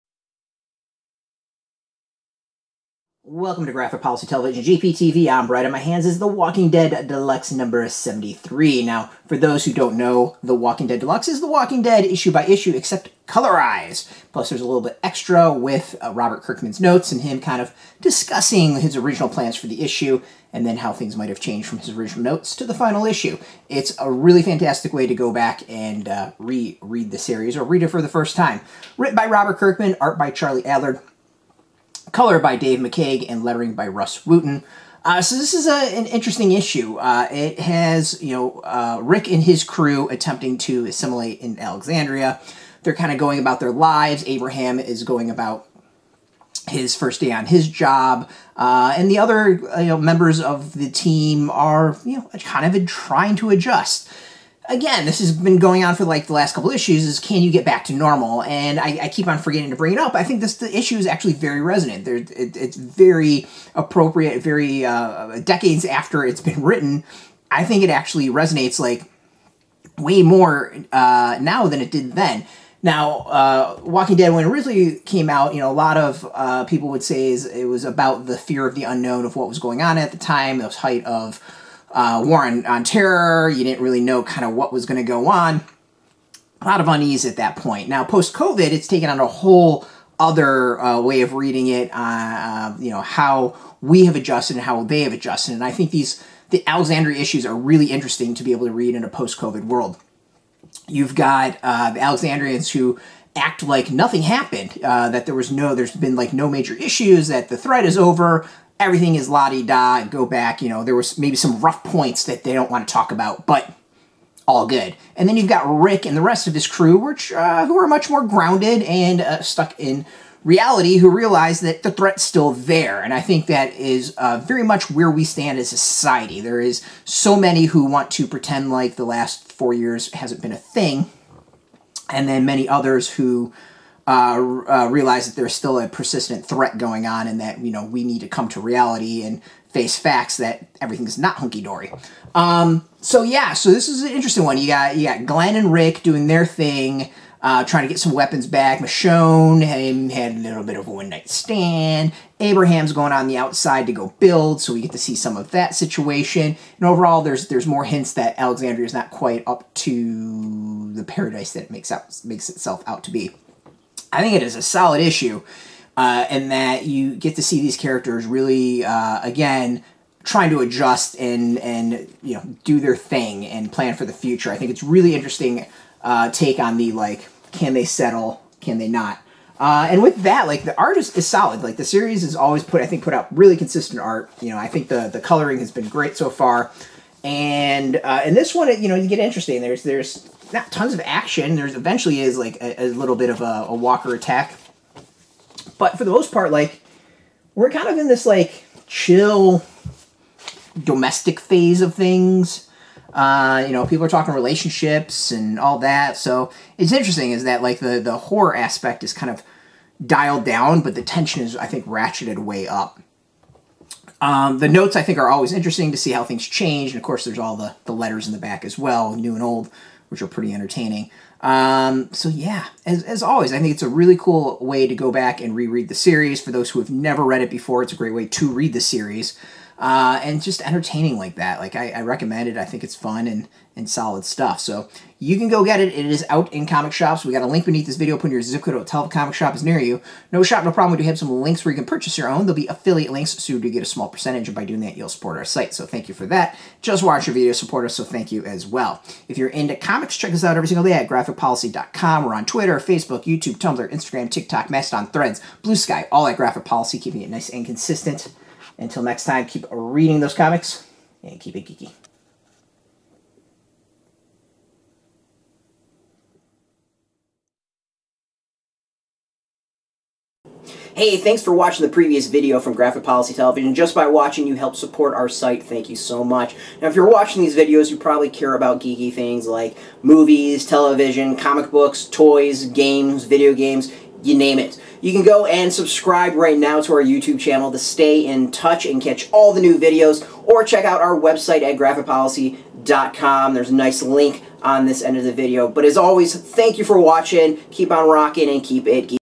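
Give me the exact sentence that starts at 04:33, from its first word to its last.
Just by watching, you help support our site.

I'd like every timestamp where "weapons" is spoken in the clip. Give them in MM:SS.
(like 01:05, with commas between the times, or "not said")
02:28.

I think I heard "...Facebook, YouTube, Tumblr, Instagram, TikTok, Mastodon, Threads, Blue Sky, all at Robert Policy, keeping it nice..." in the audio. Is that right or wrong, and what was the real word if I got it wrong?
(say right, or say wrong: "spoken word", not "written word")
wrong: "Graphic", not "Robert".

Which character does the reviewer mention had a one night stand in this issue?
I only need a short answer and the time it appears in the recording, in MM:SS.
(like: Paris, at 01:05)
Michonne, at 02:28.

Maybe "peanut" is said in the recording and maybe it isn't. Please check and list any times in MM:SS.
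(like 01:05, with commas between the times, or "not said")
not said.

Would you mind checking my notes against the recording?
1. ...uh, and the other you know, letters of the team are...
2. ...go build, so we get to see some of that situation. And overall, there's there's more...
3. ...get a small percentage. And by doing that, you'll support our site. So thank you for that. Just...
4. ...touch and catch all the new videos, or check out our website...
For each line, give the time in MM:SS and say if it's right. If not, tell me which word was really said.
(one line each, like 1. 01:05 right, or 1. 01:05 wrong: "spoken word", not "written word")
1. 00:48 wrong: "members", not "letters"
2. 02:33 right
3. 04:03 right
4. 04:48 right.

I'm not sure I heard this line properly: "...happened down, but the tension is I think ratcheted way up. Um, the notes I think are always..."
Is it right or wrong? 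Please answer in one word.
wrong.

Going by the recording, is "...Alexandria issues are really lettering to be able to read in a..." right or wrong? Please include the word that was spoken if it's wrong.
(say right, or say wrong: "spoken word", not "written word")
wrong: "interesting", not "lettering".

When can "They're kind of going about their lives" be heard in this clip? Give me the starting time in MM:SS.
00:42.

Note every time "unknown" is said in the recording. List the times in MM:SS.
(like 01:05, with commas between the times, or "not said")
01:18.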